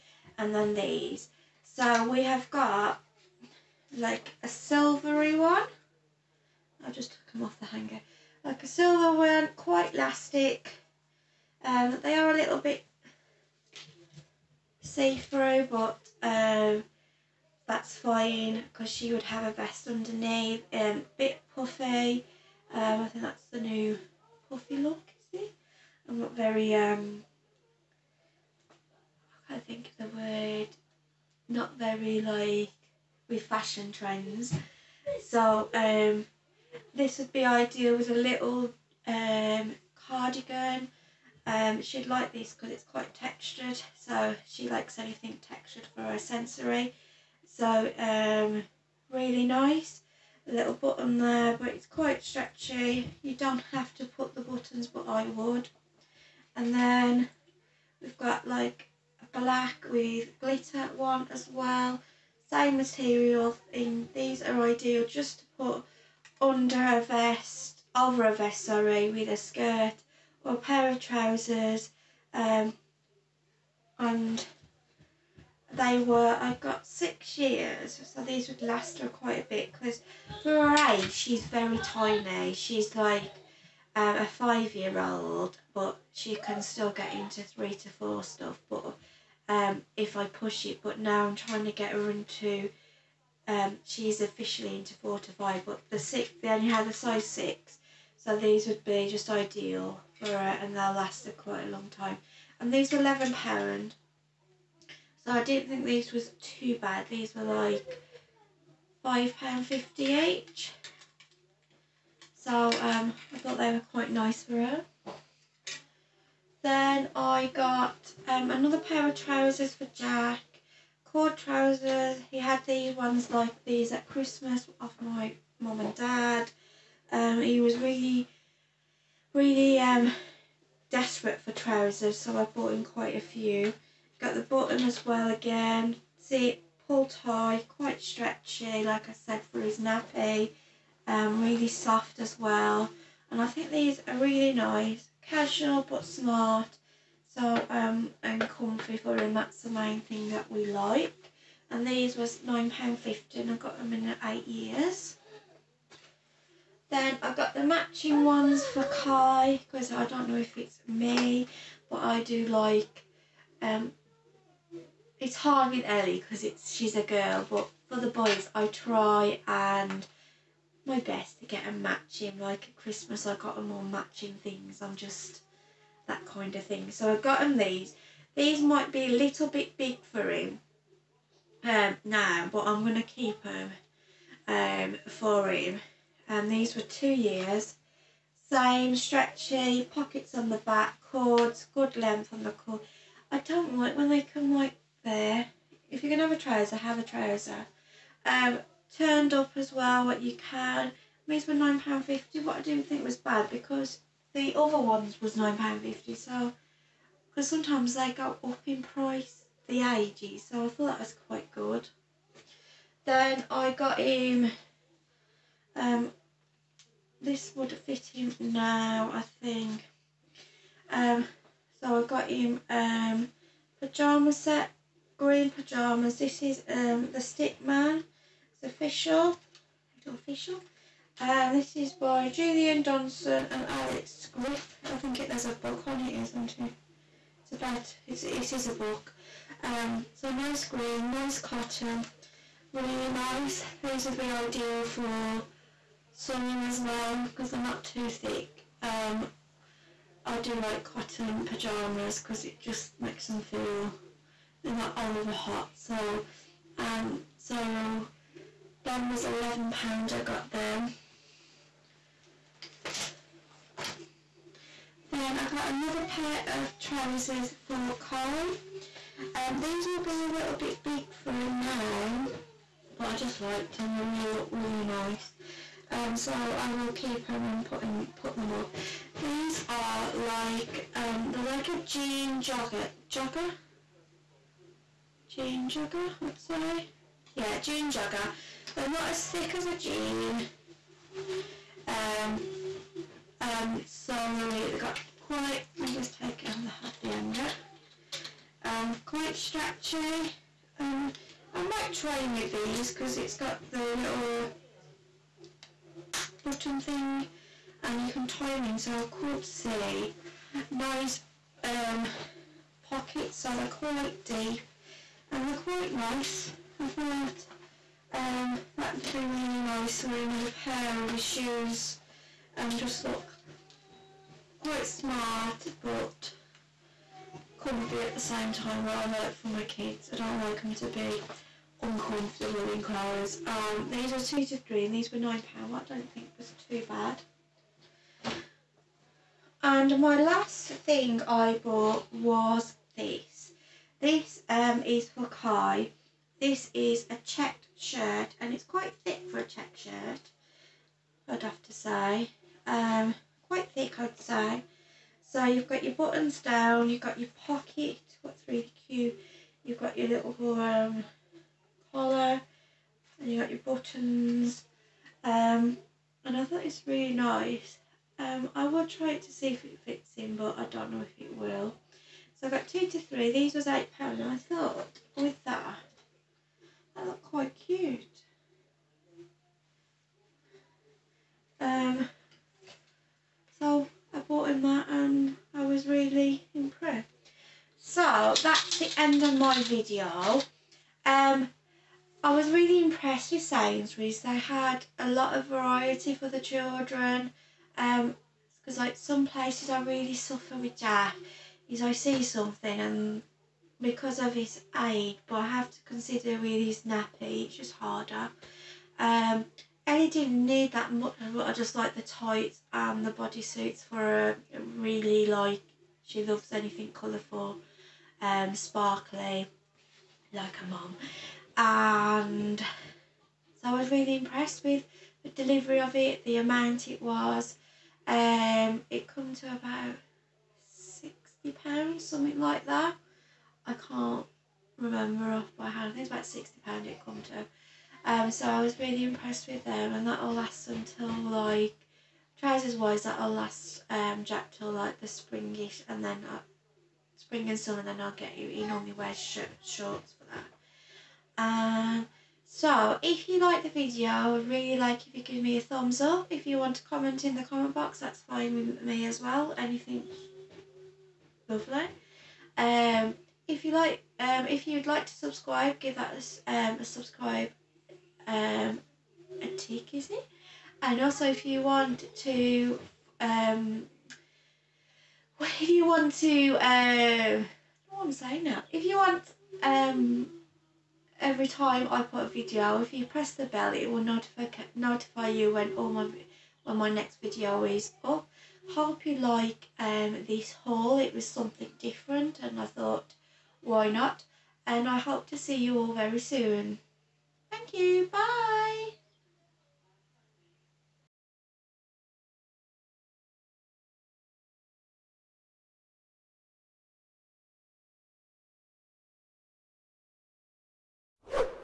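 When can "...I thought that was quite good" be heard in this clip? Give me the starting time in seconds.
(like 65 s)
210 s.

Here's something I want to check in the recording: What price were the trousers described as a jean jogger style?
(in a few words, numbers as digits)
£9.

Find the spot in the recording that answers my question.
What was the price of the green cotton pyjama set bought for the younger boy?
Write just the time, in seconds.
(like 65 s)
259 s.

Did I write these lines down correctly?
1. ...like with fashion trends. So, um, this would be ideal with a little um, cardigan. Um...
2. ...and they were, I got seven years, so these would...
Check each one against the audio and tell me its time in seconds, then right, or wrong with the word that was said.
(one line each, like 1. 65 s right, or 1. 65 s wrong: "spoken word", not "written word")
1. 32 s right
2. 73 s wrong: "six", not "seven".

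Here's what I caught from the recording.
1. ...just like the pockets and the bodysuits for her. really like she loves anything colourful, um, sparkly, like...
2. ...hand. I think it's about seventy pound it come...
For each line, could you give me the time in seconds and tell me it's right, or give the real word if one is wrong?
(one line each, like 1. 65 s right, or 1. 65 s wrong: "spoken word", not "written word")
1. 411 s wrong: "tights", not "pockets"
2. 435 s wrong: "sixty", not "seventy".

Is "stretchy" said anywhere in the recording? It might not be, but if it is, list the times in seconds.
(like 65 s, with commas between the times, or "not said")
52 s, 138 s, 188 s, 299 s.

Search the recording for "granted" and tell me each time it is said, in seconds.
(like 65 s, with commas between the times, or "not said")
not said.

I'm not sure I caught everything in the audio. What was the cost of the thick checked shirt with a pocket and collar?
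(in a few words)
£8.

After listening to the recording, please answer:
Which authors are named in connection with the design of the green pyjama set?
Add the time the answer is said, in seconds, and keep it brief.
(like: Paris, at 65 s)
Julia Donaldson and Alex Griff, at 232 s.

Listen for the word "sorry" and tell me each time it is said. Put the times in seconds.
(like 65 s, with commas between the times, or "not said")
68 s.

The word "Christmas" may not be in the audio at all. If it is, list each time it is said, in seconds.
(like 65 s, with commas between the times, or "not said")
124 s, 172 s.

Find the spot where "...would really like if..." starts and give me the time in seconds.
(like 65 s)
454 s.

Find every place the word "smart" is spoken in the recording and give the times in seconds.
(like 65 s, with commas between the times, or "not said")
146 s, 324 s.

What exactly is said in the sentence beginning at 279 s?
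These are like um, they're like a jean jogger jogger.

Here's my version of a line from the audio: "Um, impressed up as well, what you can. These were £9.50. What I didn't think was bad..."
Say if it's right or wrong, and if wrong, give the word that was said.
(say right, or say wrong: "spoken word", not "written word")
wrong: "turned", not "impressed".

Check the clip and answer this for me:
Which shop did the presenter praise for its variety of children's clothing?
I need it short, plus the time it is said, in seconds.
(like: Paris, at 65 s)
Sainsbury's, at 393 s.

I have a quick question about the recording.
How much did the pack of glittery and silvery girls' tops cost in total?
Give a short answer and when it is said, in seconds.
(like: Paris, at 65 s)
£11, at 102 s.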